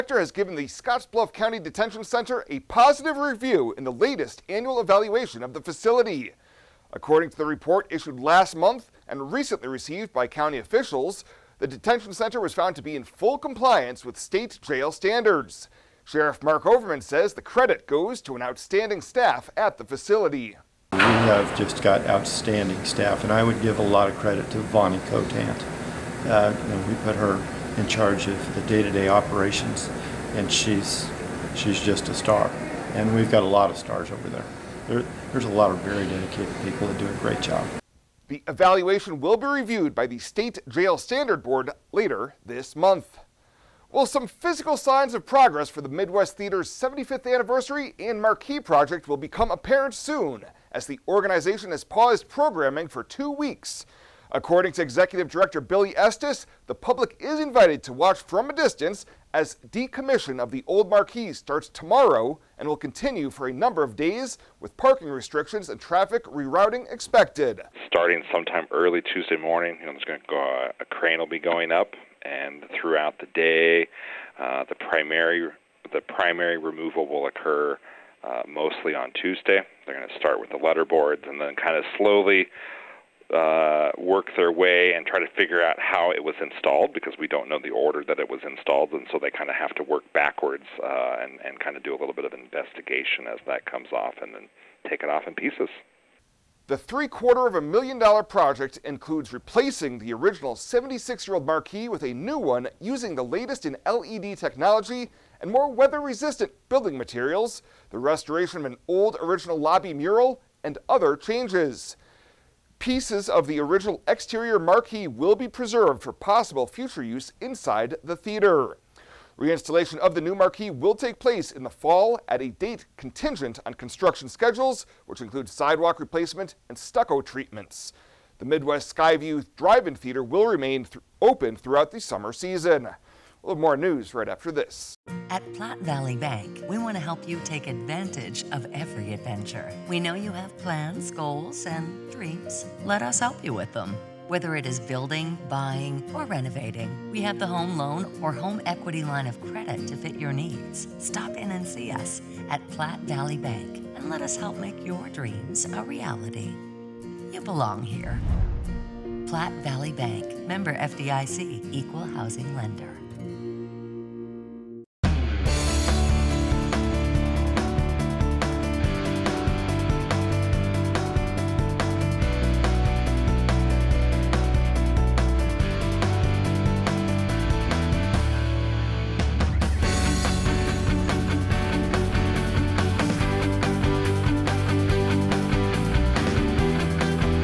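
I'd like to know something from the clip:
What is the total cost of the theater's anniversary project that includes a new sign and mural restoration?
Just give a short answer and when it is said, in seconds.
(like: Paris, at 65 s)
$750,000, at 96 s.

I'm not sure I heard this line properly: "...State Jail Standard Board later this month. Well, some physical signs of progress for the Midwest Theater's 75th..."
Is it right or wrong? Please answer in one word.
right.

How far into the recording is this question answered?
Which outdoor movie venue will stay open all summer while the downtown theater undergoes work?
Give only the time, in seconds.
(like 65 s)
128 s.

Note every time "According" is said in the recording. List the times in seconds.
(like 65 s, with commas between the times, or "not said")
6 s, 54 s.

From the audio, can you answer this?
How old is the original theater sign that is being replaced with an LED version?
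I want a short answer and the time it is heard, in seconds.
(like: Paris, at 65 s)
76 years, at 100 s.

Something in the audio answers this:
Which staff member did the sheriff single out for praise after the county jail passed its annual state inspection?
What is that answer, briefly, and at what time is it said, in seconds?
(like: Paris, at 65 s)
Vonnie Cotant, at 24 s.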